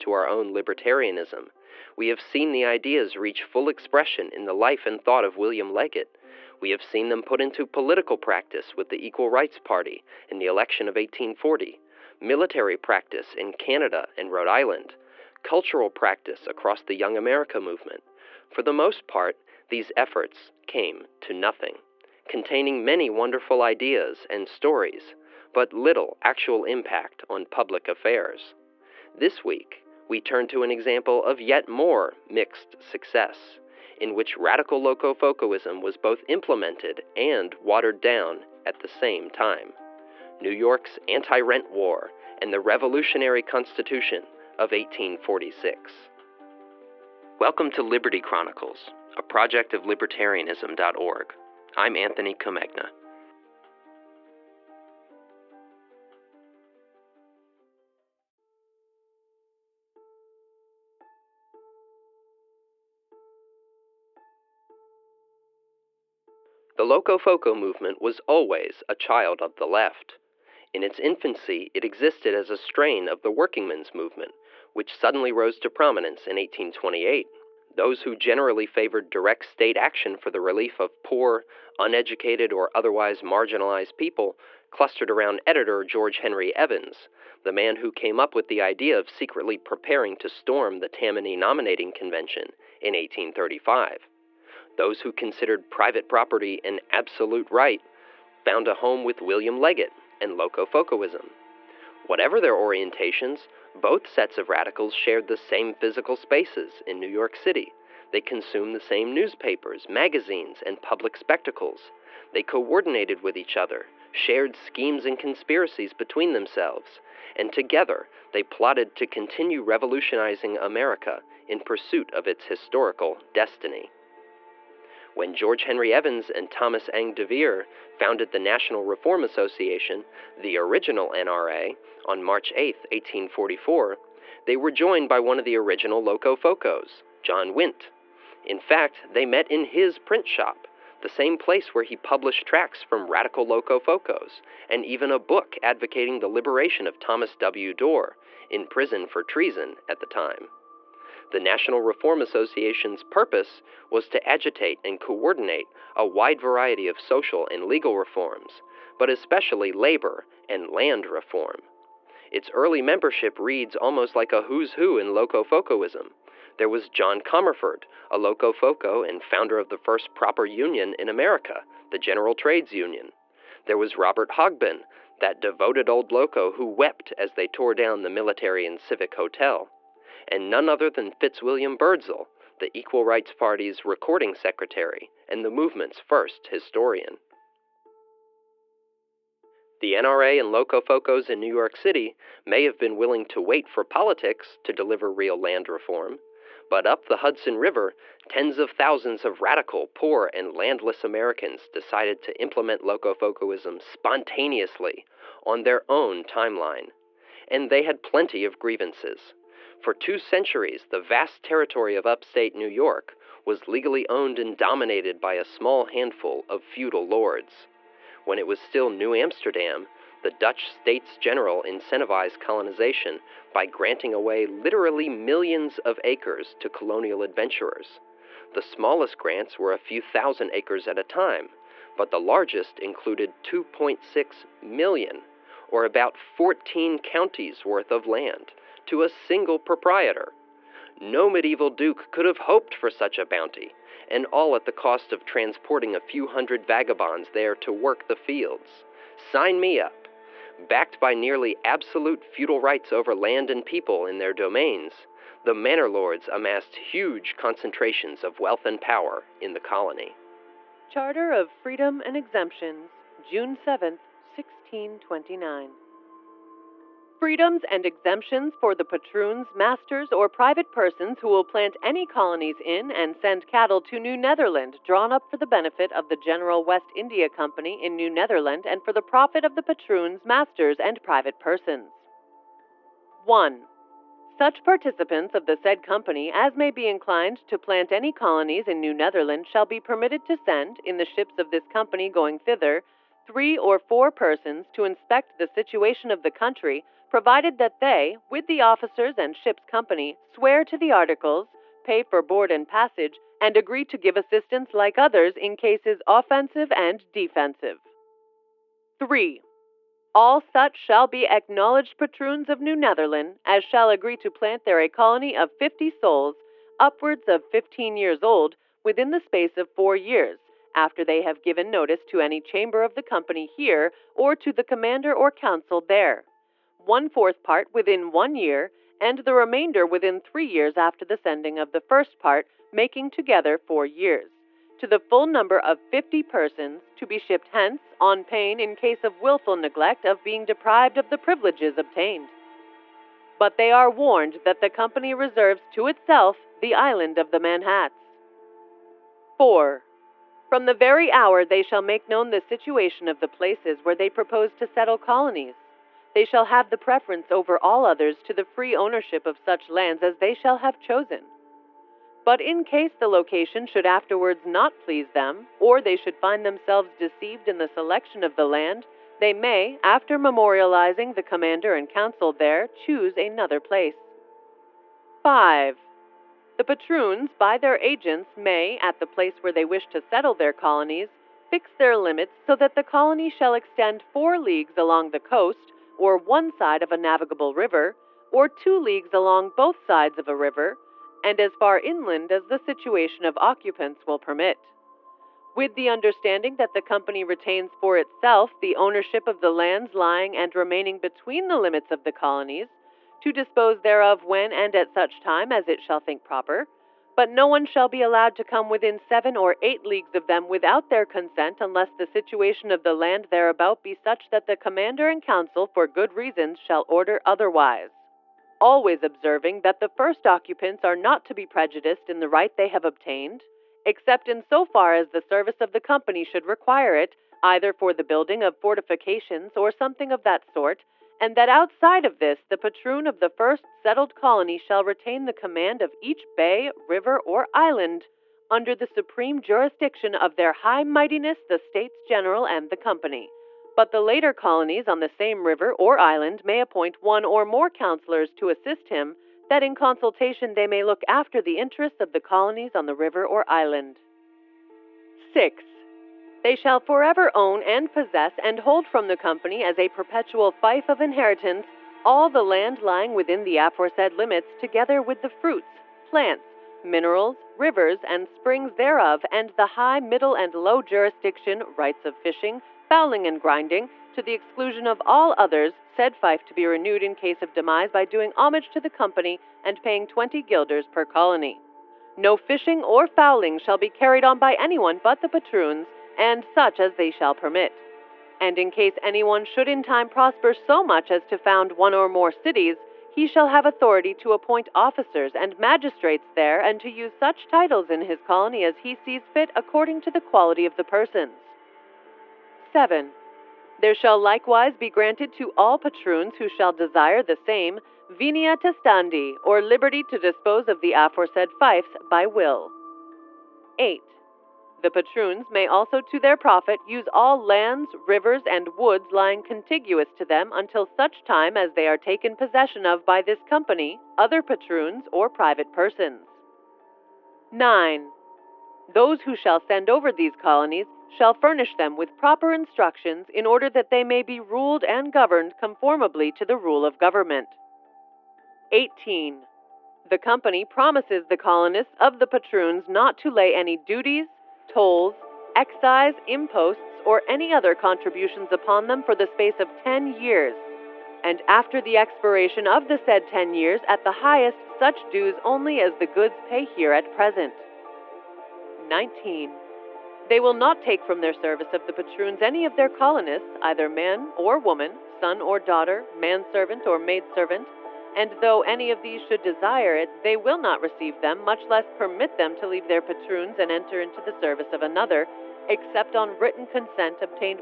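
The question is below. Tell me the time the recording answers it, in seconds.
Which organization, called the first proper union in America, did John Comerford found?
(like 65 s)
171 s.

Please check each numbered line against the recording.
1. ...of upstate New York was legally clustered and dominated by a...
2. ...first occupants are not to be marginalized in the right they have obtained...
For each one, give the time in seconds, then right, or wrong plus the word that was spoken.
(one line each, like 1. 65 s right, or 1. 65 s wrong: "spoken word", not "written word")
1. 211 s wrong: "owned", not "clustered"
2. 419 s wrong: "prejudiced", not "marginalized".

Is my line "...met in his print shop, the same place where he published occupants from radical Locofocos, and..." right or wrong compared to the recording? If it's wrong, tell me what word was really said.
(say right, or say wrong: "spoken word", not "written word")
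wrong: "tracts", not "occupants".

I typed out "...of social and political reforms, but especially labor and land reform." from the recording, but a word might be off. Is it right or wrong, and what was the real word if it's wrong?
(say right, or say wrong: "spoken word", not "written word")
wrong: "legal", not "political".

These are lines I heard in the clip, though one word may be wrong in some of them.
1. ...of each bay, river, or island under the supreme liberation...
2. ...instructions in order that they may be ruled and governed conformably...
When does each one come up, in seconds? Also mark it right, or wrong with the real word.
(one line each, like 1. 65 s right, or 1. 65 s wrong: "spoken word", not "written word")
1. 435 s wrong: "jurisdiction", not "liberation"
2. 532 s right.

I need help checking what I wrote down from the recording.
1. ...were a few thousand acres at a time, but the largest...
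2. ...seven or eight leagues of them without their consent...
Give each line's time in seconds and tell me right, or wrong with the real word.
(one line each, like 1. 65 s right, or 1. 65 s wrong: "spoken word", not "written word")
1. 229 s right
2. 408 s right.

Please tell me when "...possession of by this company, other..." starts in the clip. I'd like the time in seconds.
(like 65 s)
522 s.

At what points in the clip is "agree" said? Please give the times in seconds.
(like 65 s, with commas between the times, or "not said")
303 s, 313 s.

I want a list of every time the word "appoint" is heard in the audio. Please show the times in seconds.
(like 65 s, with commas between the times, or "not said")
446 s, 494 s.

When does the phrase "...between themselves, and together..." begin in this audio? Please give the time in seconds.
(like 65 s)
115 s.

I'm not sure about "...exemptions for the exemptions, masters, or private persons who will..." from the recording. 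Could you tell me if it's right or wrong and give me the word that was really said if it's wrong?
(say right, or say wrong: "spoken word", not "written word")
wrong: "patroons", not "exemptions".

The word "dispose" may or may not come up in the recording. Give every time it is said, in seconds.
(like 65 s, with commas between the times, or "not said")
403 s, 510 s.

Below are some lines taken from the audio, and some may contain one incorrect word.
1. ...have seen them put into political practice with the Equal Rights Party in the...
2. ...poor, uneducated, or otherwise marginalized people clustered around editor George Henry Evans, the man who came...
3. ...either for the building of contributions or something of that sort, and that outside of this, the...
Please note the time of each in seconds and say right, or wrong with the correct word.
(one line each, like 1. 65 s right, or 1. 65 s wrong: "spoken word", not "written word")
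1. 6 s right
2. 81 s right
3. 427 s wrong: "fortifications", not "contributions".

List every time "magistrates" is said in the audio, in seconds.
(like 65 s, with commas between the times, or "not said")
495 s.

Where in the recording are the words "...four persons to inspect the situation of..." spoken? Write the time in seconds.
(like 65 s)
293 s.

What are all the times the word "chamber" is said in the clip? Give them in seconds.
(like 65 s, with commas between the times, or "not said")
322 s.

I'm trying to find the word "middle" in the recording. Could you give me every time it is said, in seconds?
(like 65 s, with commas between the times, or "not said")
469 s.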